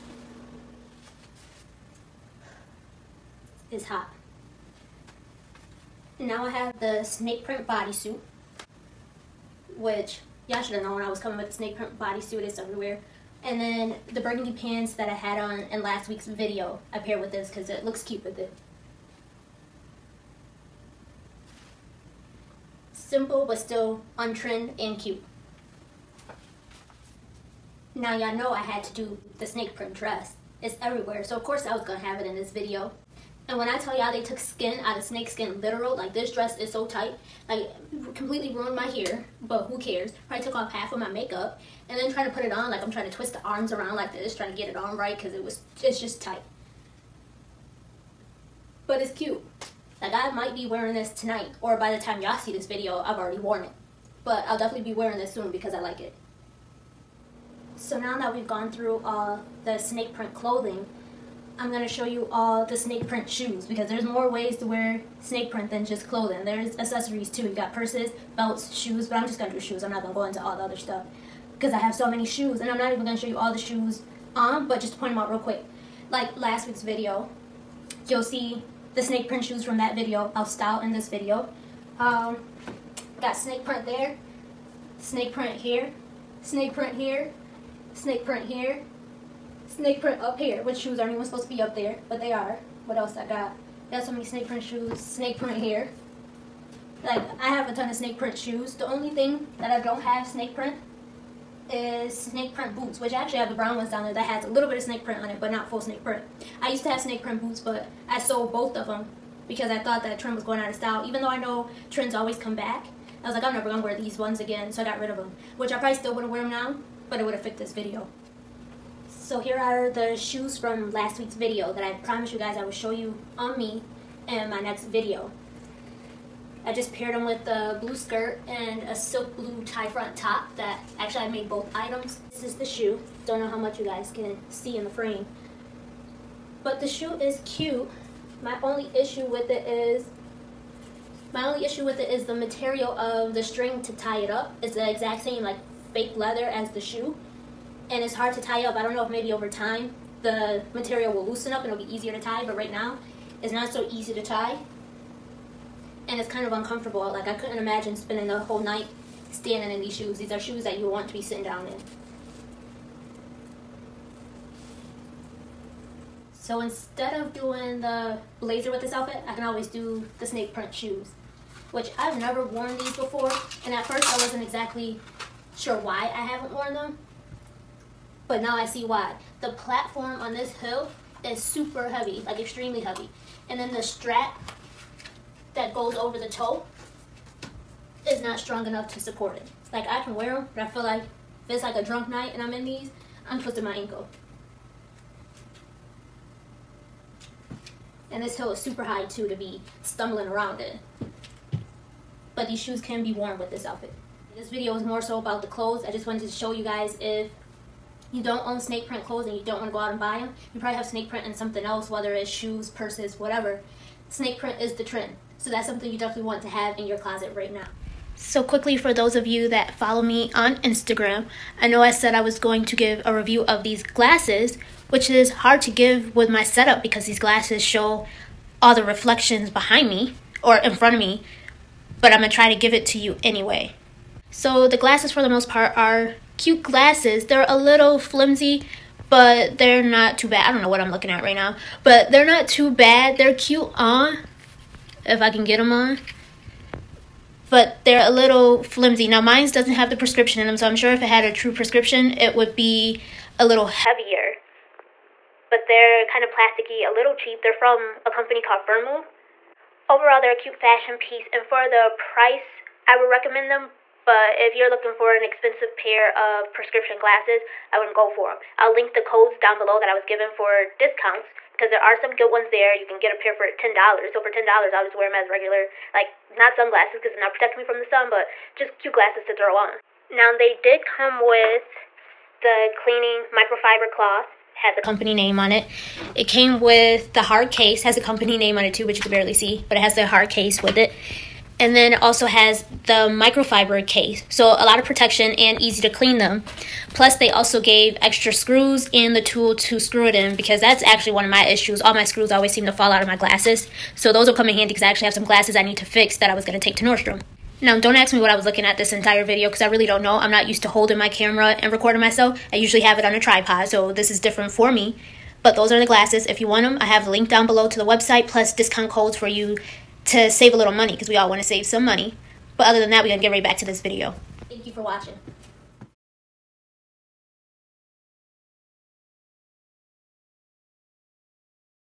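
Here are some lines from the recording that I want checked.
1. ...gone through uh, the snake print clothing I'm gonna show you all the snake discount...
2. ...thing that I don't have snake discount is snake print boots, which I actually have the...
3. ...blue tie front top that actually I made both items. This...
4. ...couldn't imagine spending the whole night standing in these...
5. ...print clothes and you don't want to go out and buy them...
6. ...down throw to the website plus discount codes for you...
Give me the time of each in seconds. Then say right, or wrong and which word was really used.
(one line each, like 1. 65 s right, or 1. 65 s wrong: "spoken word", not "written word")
1. 58 s wrong: "print", not "discount"
2. 99 s wrong: "print", not "discount"
3. 129 s right
4. 157 s right
5. 208 s right
6. 317 s wrong: "below", not "throw".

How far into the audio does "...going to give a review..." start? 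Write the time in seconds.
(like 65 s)
222 s.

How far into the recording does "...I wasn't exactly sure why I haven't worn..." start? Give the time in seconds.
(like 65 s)
174 s.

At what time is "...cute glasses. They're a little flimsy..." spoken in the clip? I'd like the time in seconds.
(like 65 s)
236 s.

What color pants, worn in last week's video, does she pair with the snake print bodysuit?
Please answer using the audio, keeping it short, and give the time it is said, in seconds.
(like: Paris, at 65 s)
burgundy, at 14 s.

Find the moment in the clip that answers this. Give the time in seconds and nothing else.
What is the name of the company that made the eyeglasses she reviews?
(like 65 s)
258 s.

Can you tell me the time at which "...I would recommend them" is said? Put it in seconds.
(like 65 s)
262 s.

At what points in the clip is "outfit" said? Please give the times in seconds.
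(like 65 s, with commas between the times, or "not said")
168 s, 203 s.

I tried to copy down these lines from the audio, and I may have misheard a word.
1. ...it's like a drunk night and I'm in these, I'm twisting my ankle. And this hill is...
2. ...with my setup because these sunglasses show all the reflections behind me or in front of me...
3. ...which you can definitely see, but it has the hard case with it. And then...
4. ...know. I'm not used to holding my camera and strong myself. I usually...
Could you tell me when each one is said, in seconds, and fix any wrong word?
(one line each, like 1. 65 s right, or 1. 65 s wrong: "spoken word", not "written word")
1. 191 s right
2. 226 s wrong: "glasses", not "sunglasses"
3. 288 s wrong: "barely", not "definitely"
4. 310 s wrong: "recording", not "strong".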